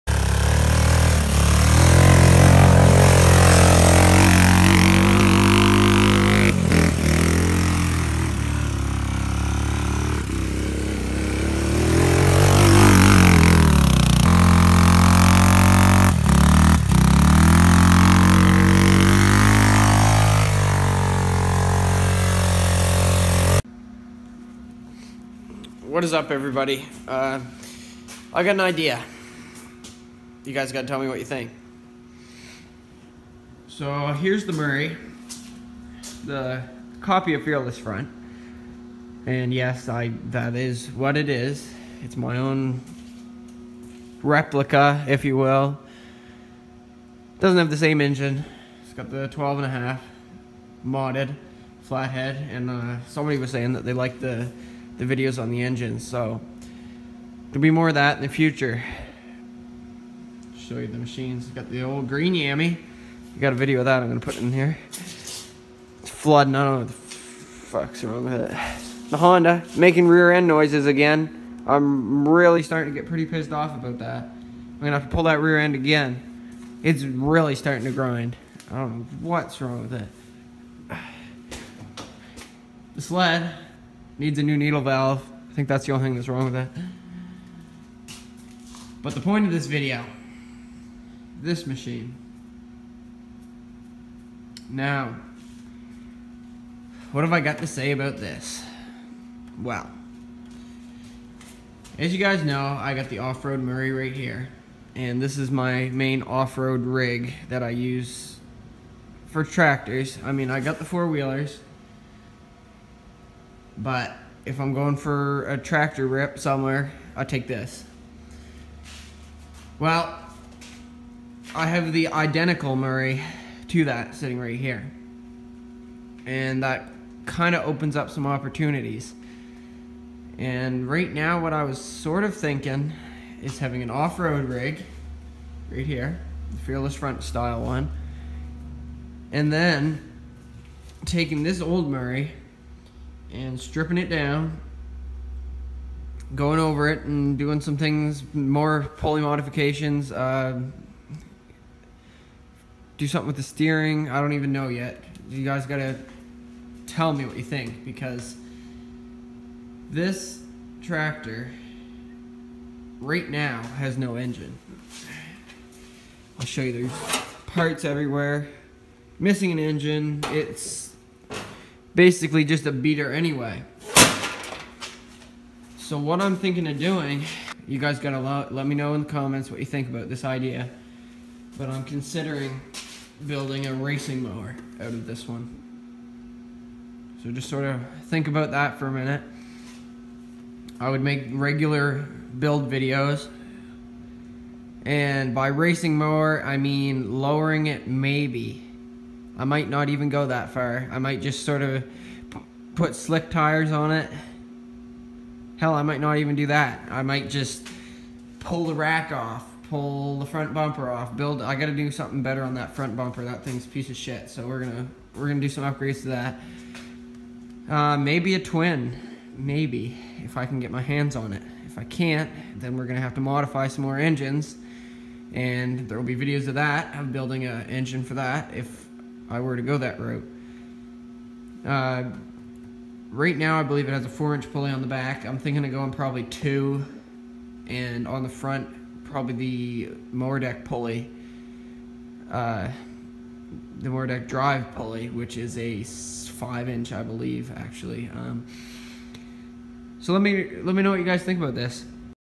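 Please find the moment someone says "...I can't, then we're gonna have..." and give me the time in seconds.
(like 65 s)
221 s.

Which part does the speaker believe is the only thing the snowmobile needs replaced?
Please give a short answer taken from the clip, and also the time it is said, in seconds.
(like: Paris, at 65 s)
needle valve, at 84 s.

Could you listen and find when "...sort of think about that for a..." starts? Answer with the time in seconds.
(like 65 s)
187 s.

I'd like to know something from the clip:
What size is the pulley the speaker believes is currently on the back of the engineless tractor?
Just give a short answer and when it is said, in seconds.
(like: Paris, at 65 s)
4-inch, at 234 s.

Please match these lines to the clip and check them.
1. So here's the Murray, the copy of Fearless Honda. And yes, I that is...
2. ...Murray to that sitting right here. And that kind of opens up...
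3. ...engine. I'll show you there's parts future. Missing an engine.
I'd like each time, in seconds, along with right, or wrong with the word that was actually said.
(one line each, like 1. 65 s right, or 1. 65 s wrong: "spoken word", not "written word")
1. 33 s wrong: "Front", not "Honda"
2. 122 s right
3. 164 s wrong: "everywhere", not "future".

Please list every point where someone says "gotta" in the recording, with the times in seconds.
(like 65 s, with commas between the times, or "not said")
155 s, 177 s, 211 s.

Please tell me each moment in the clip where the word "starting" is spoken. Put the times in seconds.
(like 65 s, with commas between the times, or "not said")
72 s, 77 s.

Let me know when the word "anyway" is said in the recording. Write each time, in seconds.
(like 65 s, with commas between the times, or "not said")
173 s.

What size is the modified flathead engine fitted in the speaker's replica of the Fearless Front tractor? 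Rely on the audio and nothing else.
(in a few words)
12 and a half.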